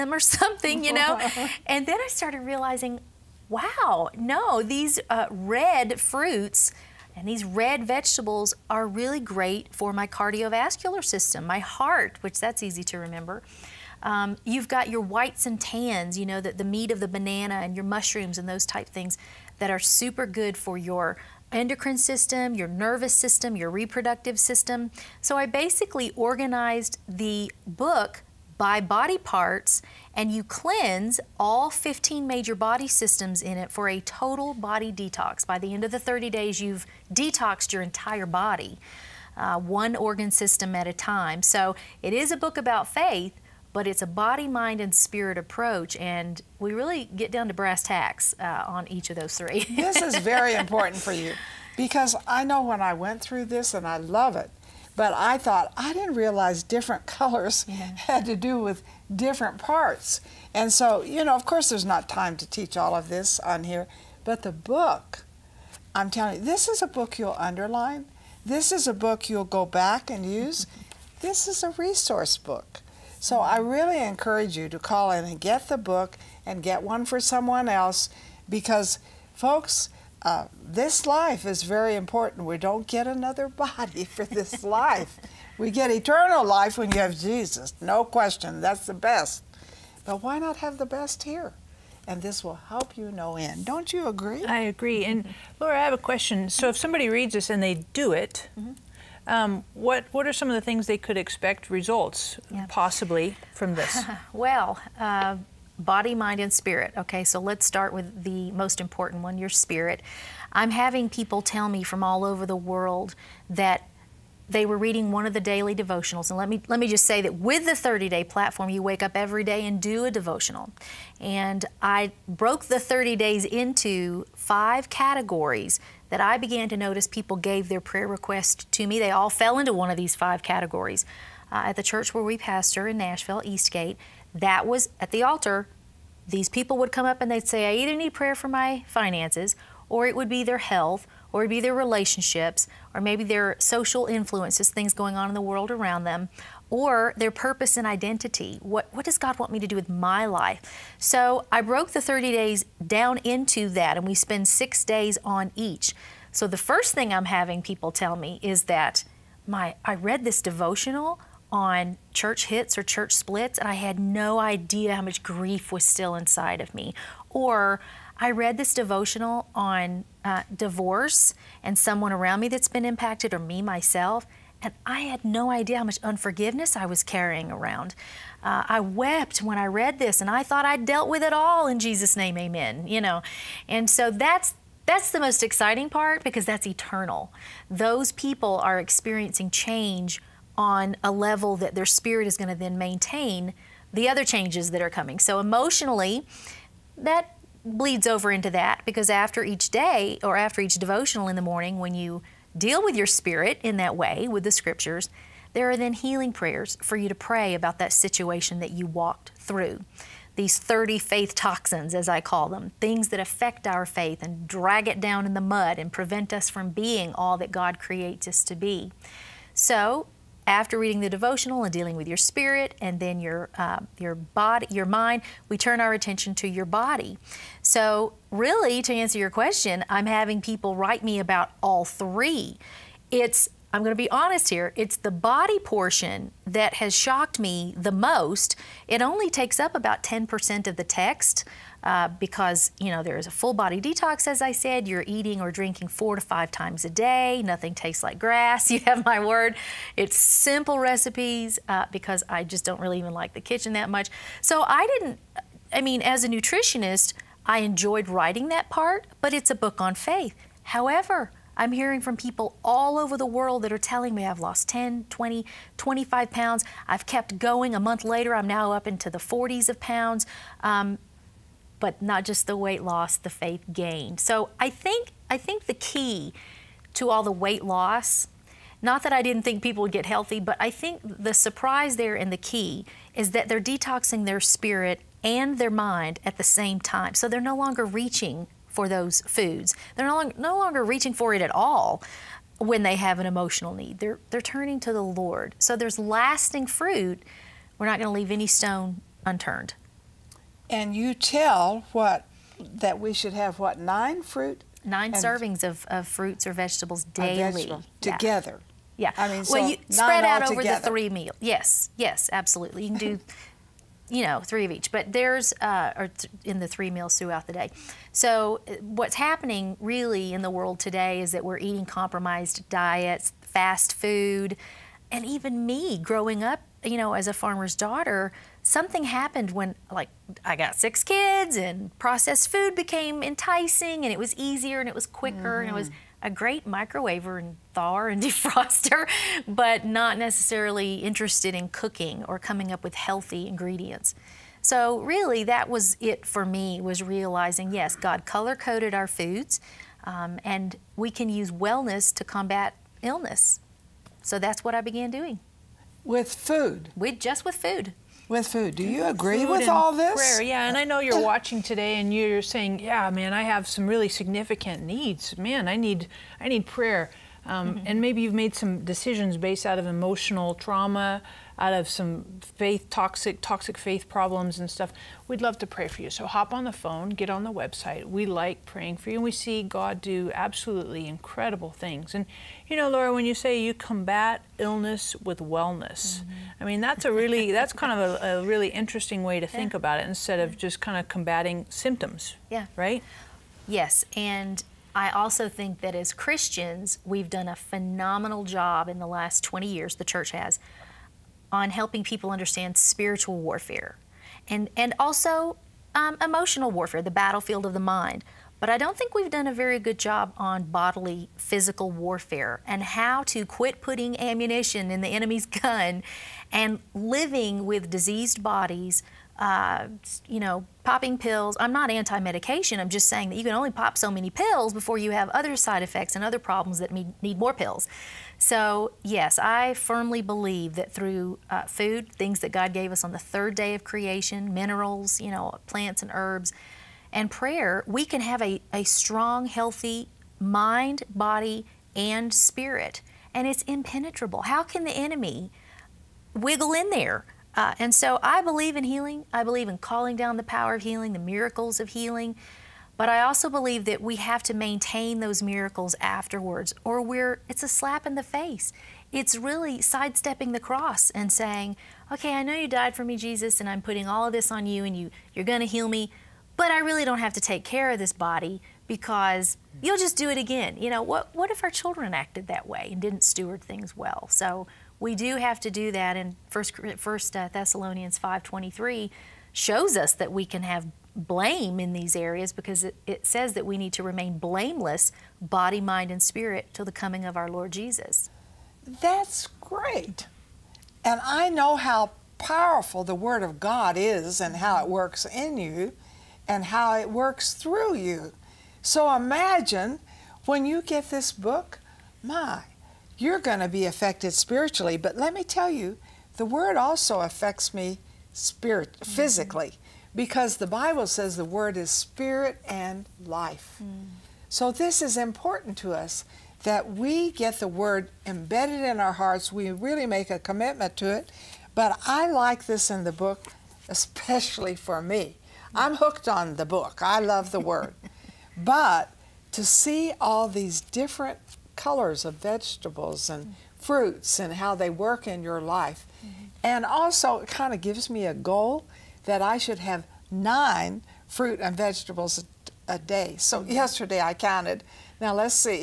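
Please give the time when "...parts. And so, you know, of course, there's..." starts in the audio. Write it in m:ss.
0:59.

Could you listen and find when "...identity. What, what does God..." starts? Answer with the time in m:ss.
2:27.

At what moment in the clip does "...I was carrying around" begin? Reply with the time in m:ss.
2:56.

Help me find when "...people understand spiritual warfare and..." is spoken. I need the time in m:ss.
6:42.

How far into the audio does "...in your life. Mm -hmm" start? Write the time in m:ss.
8:55.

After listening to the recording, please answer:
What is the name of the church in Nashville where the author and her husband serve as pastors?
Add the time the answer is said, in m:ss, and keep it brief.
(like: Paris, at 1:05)
Eastgate, at 2:13.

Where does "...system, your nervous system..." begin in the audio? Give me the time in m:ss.
0:21.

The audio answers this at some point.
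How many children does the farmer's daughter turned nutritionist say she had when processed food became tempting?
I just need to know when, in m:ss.
5:30.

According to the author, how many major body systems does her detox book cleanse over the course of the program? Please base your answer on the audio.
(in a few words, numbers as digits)
15.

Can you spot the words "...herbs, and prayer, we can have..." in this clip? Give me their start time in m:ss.
7:16.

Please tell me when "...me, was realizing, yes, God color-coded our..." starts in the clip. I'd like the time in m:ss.
5:46.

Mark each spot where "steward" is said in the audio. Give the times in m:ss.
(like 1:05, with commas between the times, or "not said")
7:53.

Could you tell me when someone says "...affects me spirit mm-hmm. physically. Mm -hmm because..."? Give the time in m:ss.
8:27.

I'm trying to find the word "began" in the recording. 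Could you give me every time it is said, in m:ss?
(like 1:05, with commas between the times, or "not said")
2:06, 5:54.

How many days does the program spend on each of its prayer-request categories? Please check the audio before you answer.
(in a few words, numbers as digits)
6.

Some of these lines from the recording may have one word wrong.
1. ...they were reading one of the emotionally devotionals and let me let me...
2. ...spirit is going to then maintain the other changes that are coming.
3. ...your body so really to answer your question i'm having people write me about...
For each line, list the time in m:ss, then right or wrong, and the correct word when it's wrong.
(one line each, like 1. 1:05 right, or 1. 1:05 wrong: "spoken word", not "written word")
1. 1:54 wrong: "daily", not "emotionally"
2. 3:11 right
3. 3:46 right.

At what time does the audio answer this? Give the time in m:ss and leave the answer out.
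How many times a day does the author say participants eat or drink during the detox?
4:05.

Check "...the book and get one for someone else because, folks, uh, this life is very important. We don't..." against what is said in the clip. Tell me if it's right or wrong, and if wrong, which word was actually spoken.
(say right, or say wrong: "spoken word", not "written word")
right.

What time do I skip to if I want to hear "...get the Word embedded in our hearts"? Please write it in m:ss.
8:37.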